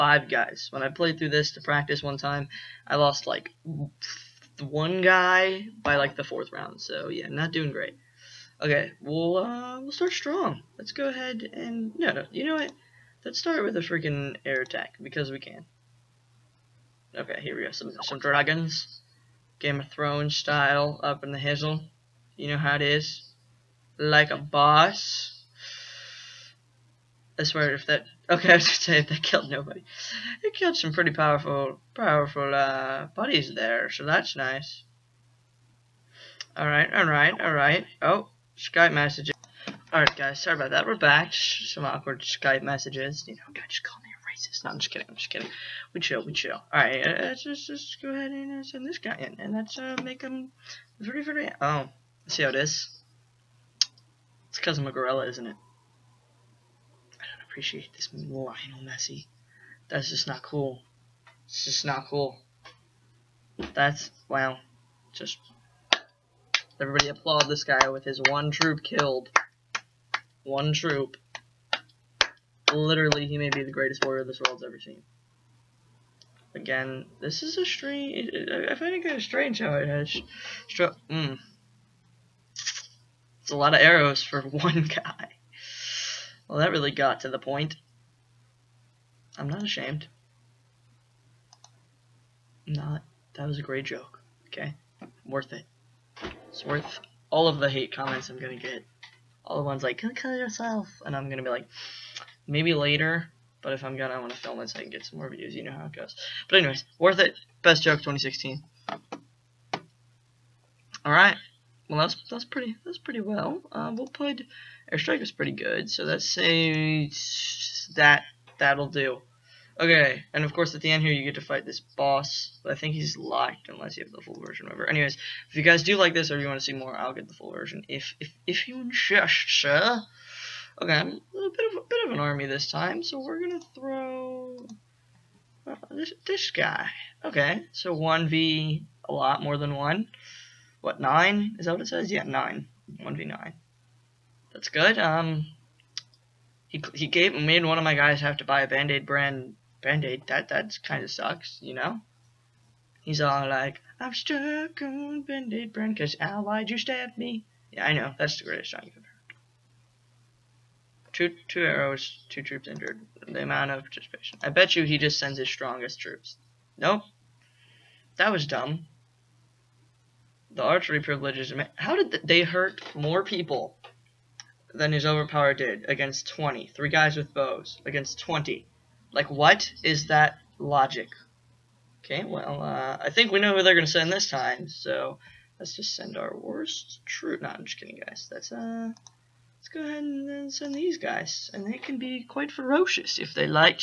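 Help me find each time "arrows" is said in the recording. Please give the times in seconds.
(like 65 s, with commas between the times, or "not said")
83 s, 161 s.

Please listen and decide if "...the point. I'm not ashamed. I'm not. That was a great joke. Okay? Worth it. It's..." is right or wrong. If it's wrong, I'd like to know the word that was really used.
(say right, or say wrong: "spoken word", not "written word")
right.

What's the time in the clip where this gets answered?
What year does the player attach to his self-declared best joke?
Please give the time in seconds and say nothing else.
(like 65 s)
107 s.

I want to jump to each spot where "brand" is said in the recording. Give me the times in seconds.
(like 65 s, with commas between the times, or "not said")
149 s, 155 s.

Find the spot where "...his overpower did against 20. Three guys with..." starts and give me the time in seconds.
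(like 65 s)
174 s.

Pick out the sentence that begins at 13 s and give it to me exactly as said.
Let's start with a freaking air attack because we can.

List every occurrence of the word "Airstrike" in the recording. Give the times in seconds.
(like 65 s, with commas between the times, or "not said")
114 s.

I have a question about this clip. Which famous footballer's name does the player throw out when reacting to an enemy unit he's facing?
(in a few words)
Lionel Messi.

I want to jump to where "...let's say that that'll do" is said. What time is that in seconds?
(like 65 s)
116 s.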